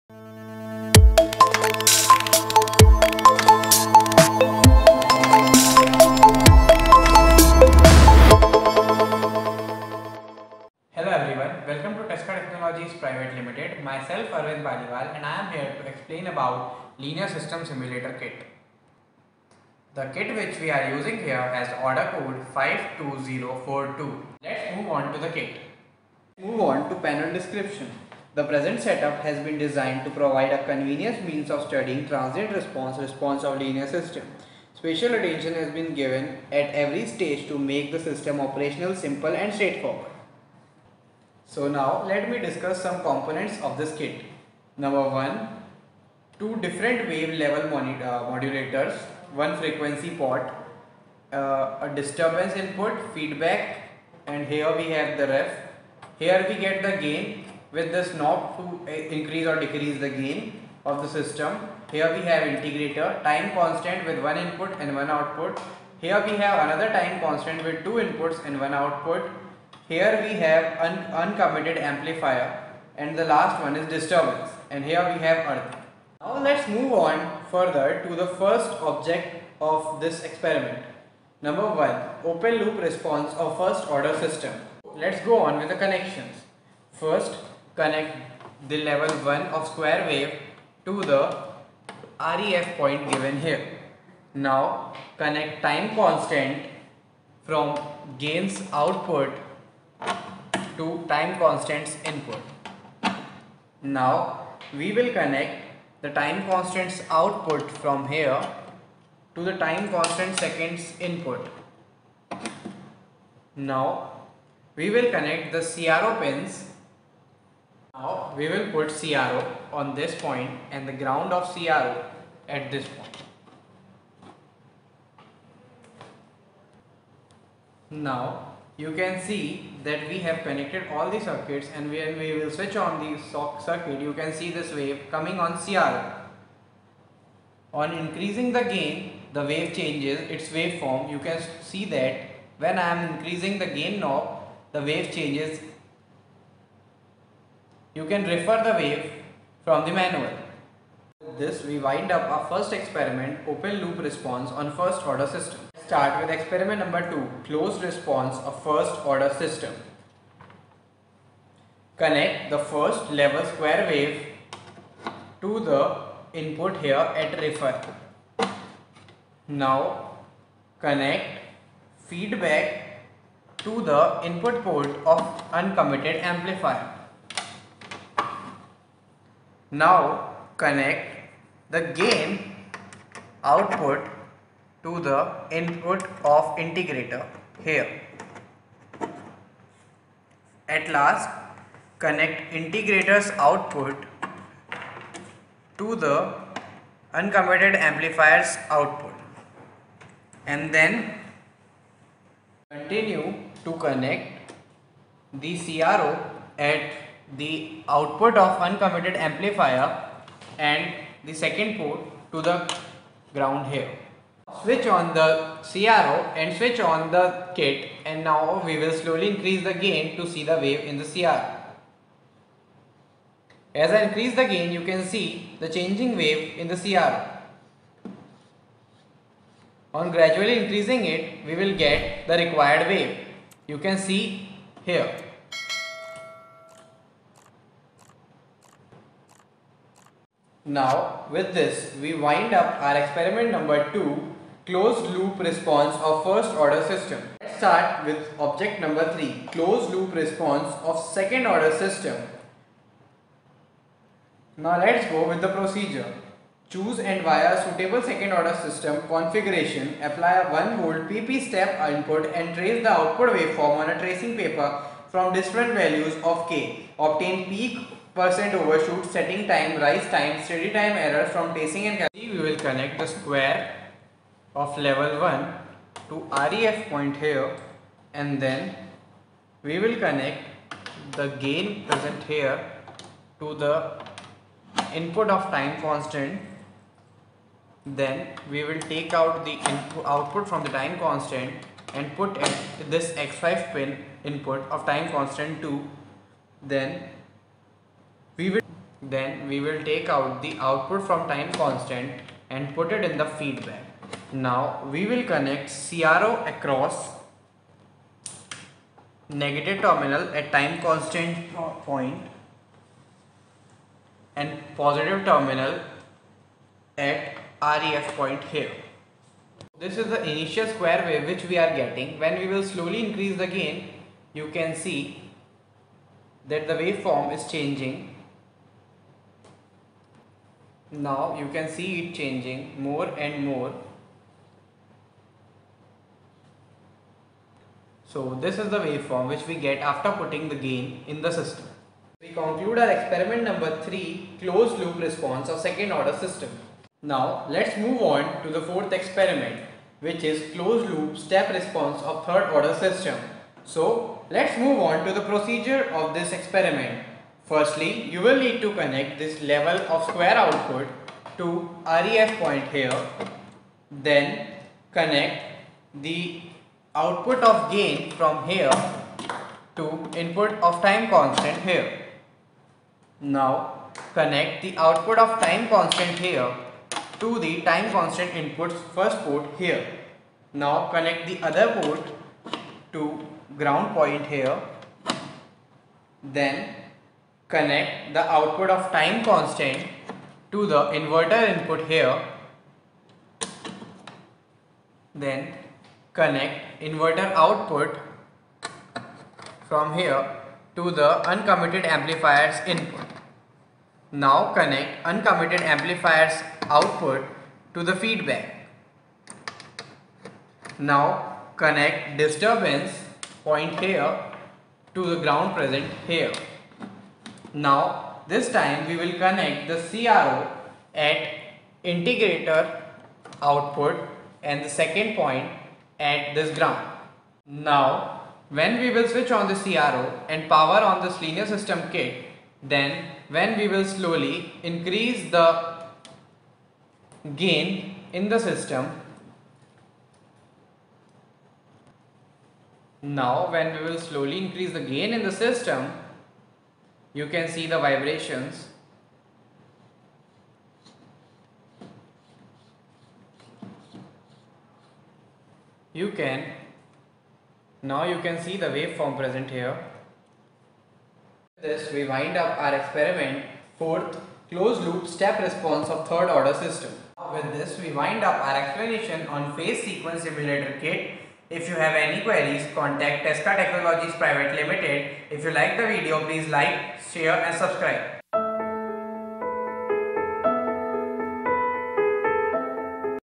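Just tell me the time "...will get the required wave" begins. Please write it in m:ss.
3:51.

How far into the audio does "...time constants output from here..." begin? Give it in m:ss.
1:46.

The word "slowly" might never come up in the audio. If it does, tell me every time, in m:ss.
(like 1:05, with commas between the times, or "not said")
3:38, 5:22, 7:13, 7:23.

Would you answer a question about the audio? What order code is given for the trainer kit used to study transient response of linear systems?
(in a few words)
52042.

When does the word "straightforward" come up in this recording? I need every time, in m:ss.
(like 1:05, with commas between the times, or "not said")
0:39.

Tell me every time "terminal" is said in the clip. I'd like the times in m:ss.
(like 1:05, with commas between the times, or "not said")
5:09, 5:15.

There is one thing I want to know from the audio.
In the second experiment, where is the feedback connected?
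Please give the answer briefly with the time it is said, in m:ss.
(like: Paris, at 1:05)
Uncommitted amplifier input, at 2:54.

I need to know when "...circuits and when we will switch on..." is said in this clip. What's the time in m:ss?
2:11.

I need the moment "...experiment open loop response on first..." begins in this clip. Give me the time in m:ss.
2:32.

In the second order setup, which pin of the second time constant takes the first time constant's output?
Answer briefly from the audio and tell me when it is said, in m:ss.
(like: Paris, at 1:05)
x5, at 4:53.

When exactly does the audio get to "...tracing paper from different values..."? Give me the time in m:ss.
4:23.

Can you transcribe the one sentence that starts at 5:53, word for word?
So let's move on to the procedure of this experiment.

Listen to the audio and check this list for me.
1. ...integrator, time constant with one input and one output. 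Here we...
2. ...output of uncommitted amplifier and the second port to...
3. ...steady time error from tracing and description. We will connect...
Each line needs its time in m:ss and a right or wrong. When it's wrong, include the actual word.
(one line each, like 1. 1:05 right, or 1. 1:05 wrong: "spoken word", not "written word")
1. 1:02 right
2. 3:27 right
3. 4:30 wrong: "calculation", not "description".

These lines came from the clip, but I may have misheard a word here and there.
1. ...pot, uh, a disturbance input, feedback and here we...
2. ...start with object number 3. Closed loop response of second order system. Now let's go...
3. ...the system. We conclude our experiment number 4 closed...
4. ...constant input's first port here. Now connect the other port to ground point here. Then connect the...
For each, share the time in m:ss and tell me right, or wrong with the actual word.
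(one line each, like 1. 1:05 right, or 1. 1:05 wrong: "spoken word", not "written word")
1. 0:50 right
2. 4:07 right
3. 5:41 wrong: "3", not "4"
4. 6:17 right.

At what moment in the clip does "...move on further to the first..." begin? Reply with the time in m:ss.
1:16.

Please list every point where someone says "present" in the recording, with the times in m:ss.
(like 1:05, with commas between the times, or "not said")
0:28, 4:41, 6:55, 7:39.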